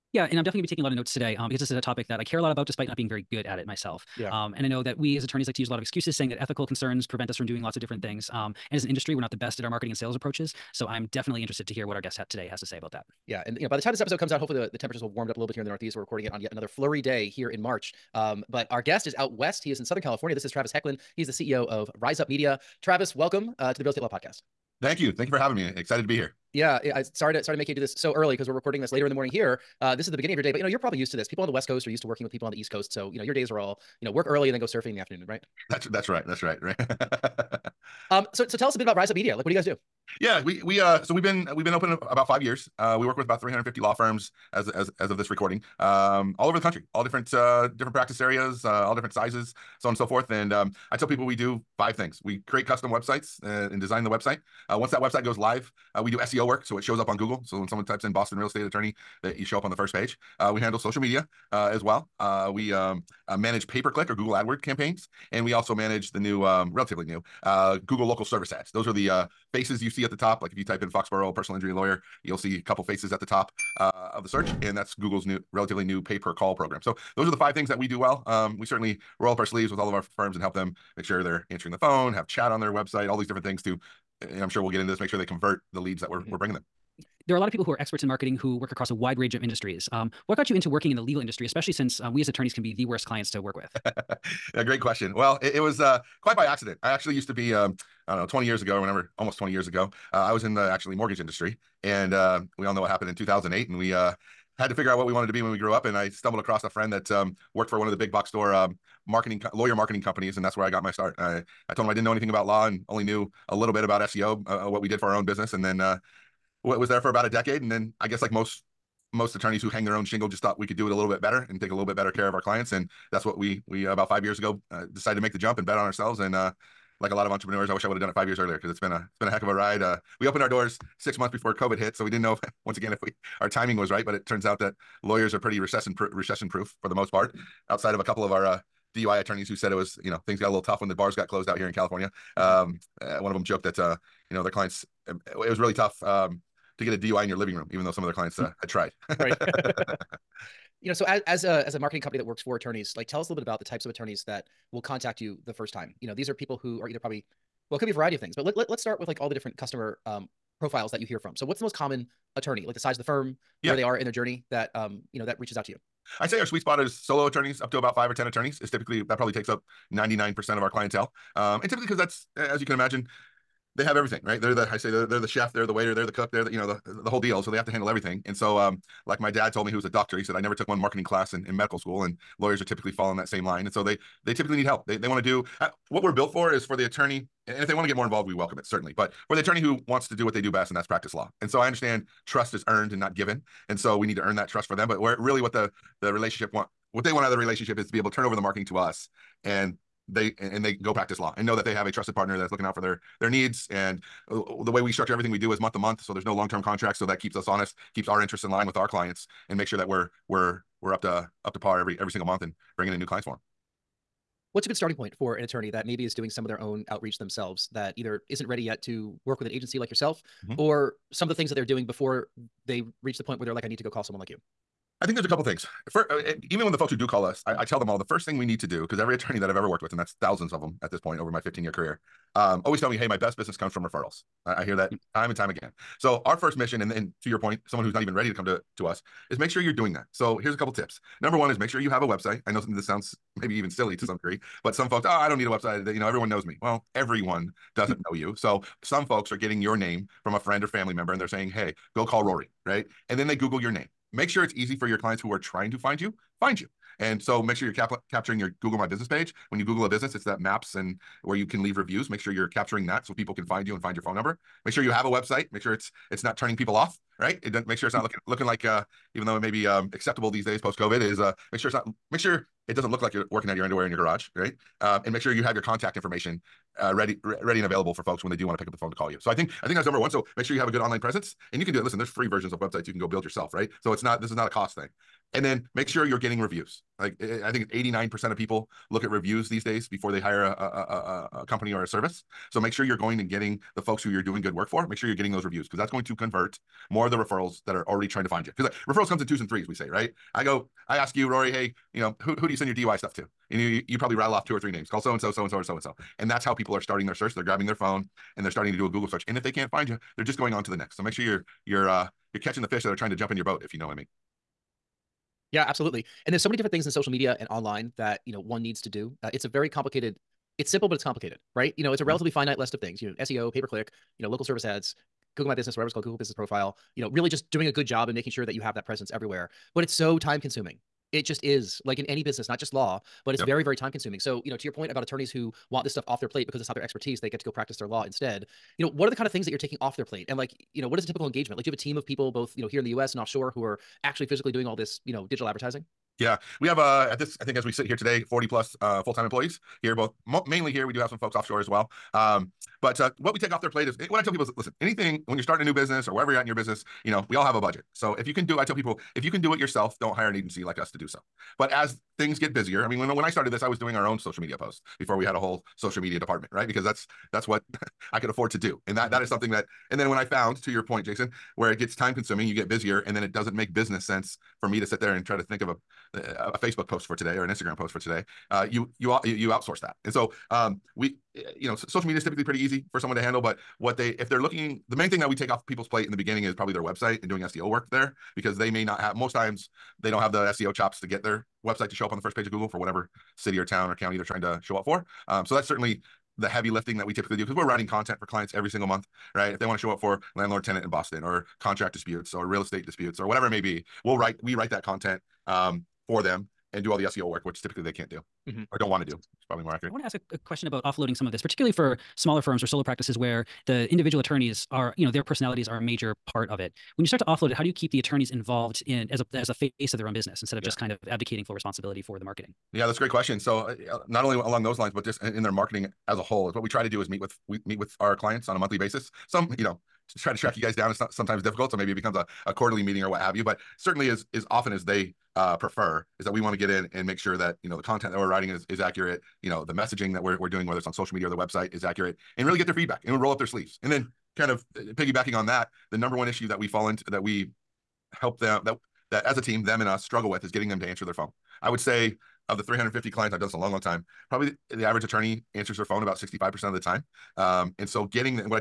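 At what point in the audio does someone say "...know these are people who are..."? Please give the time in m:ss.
2:36.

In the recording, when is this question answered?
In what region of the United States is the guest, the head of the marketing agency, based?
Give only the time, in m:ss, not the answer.
0:19.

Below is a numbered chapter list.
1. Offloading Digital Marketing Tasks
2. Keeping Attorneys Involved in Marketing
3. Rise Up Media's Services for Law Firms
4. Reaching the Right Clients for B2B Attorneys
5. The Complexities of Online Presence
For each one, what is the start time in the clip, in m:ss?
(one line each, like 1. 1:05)
1. 3:34
2. 6:49
3. 0:24
4. 2:30
5. 5:15.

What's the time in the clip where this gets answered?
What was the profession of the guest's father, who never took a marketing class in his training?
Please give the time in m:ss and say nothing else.
2:59.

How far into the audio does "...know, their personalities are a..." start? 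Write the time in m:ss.
6:55.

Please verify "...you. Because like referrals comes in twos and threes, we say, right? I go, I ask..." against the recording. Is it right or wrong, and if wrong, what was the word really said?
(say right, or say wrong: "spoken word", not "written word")
right.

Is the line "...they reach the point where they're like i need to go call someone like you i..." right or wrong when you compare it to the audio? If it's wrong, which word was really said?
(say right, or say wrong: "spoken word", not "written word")
right.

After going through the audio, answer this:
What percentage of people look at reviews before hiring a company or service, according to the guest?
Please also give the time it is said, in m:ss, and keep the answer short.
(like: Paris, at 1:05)
89%, at 4:47.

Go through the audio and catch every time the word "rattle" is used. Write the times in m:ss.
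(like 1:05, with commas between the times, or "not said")
5:04.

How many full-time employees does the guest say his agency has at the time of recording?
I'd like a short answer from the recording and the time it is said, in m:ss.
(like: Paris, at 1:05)
40+, at 5:48.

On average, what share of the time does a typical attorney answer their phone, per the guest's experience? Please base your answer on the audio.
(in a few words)
65%.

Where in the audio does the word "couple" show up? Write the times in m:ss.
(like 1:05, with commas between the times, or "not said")
1:12, 2:18, 3:45, 4:00.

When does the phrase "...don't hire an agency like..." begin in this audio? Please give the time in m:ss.
6:00.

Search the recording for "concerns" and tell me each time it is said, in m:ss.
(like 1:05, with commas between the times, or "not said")
0:06.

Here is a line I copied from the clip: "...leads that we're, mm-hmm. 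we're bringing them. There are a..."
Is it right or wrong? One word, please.
right.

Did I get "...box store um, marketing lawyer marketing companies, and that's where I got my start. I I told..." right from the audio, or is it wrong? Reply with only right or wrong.
right.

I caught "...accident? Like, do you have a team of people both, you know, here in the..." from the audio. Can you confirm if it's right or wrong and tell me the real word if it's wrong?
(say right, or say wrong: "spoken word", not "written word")
wrong: "engagement", not "accident".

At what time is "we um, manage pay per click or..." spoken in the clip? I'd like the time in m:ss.
1:02.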